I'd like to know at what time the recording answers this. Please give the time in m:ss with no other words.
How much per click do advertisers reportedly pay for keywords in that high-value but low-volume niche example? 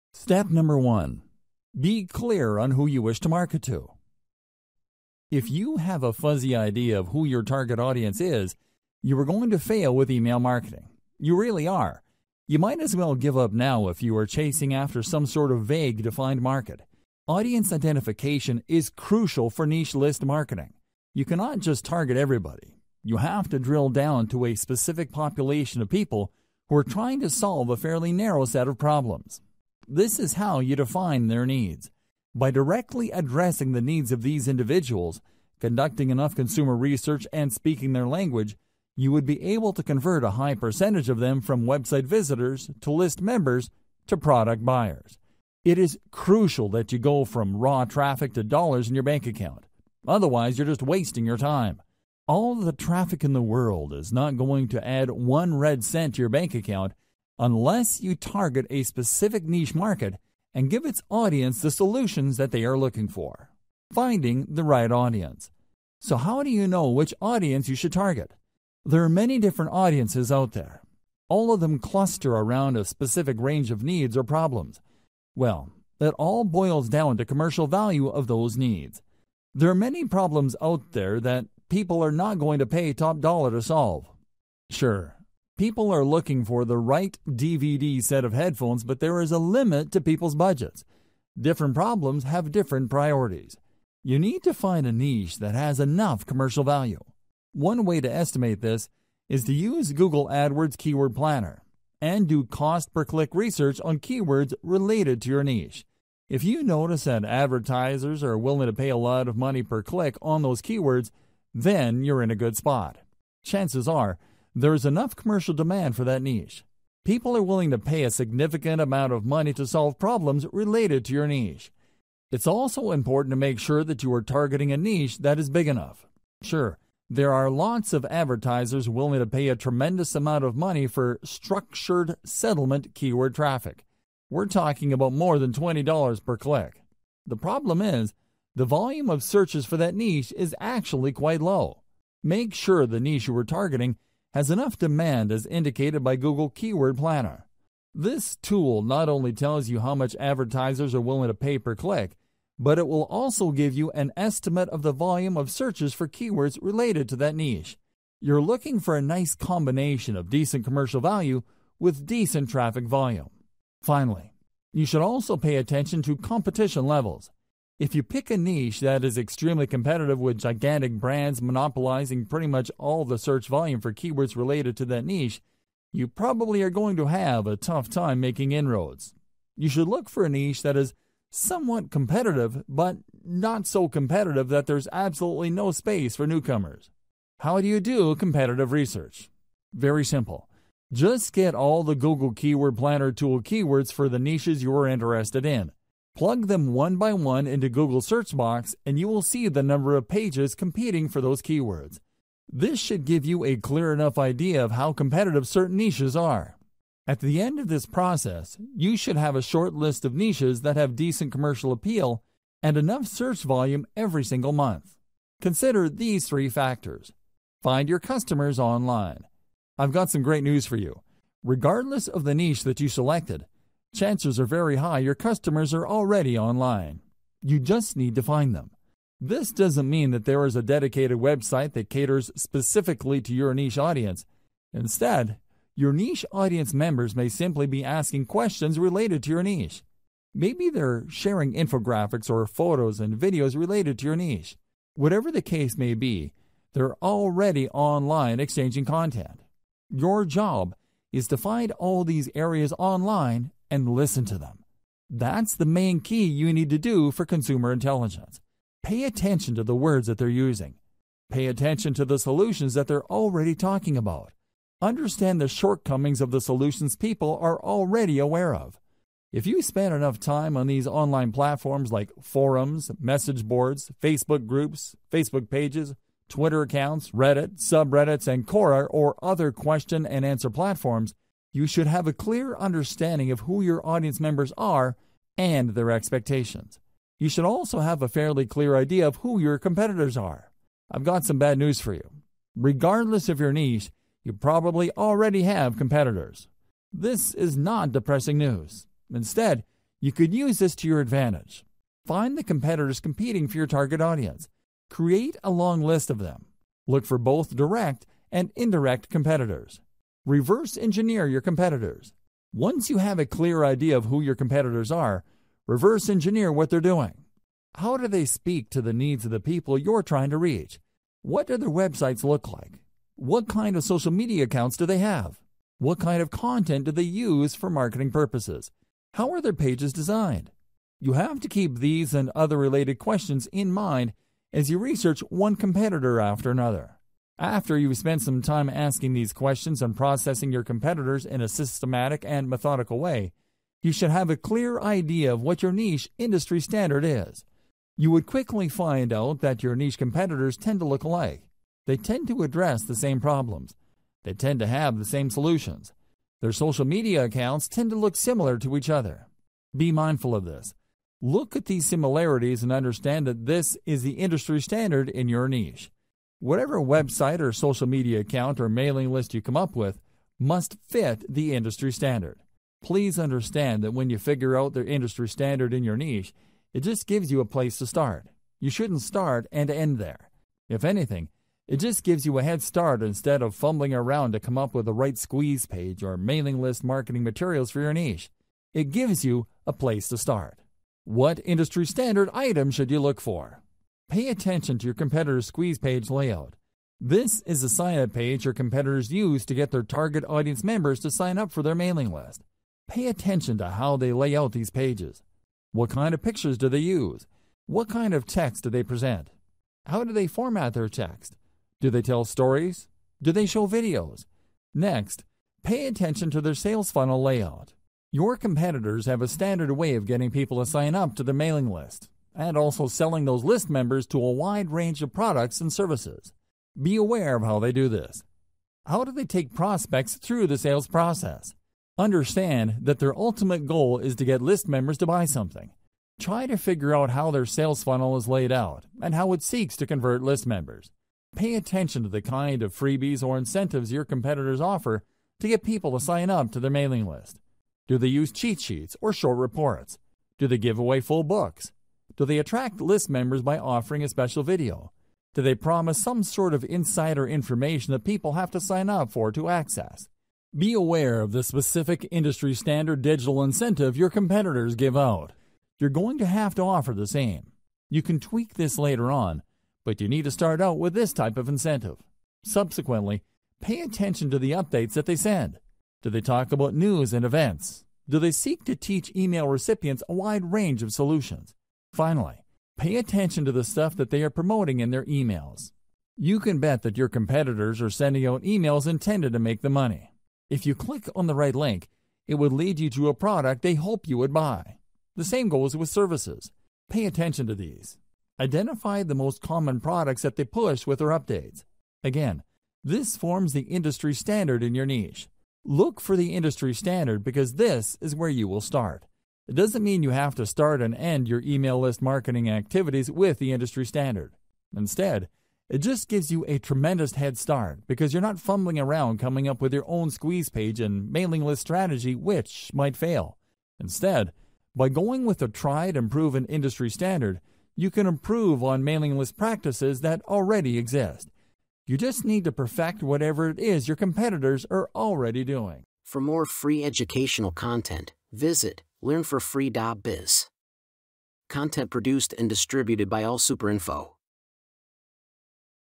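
2:15.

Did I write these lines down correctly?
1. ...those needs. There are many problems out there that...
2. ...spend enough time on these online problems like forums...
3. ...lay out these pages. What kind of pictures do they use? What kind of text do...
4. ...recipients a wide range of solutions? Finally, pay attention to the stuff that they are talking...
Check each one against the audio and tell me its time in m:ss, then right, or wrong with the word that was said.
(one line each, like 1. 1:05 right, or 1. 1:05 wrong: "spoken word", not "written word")
1. 1:18 right
2. 4:29 wrong: "platforms", not "problems"
3. 6:44 right
4. 7:59 wrong: "promoting", not "talking".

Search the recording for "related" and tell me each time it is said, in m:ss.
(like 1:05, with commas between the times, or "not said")
1:44, 2:00, 2:36, 2:54, 3:58, 4:03, 5:32.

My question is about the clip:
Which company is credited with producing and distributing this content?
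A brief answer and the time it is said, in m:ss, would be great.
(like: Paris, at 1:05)
AllSuperInfo, at 9:03.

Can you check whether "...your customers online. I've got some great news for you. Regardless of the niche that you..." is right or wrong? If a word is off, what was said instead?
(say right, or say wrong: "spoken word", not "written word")
right.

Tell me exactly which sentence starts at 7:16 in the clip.
Try to figure out how their sales funnel is laid out and how it seeks to convert list members.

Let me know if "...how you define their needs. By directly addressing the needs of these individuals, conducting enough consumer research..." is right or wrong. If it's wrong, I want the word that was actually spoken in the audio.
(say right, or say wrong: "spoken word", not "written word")
right.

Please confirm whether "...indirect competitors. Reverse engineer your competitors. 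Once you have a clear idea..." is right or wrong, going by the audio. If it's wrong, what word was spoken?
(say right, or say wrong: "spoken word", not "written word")
right.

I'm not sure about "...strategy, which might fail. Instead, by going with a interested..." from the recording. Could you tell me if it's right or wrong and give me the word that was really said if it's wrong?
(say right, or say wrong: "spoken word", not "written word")
wrong: "tried", not "interested".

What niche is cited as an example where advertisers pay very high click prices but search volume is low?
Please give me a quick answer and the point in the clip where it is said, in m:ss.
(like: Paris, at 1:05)
structured settlement, at 2:11.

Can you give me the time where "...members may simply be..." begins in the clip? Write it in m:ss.
3:56.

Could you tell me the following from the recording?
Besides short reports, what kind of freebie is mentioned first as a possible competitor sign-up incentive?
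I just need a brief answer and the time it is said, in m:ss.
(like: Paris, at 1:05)
cheat sheets, at 7:28.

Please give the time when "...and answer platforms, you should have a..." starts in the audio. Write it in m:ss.
4:40.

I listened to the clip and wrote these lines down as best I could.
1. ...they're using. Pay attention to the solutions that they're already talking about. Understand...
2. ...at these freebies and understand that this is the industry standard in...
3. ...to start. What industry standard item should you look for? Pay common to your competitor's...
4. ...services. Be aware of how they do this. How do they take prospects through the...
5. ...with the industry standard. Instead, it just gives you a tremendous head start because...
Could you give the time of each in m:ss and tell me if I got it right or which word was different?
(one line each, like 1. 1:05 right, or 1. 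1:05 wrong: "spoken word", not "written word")
1. 4:20 right
2. 6:01 wrong: "similarities", not "freebies"
3. 6:30 wrong: "attention", not "common"
4. 7:05 right
5. 8:33 right.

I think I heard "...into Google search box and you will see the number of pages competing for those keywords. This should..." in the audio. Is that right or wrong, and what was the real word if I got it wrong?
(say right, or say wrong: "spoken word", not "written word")
right.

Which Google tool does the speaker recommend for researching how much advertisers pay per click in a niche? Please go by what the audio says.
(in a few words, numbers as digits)
Google AdWords Keyword Planner.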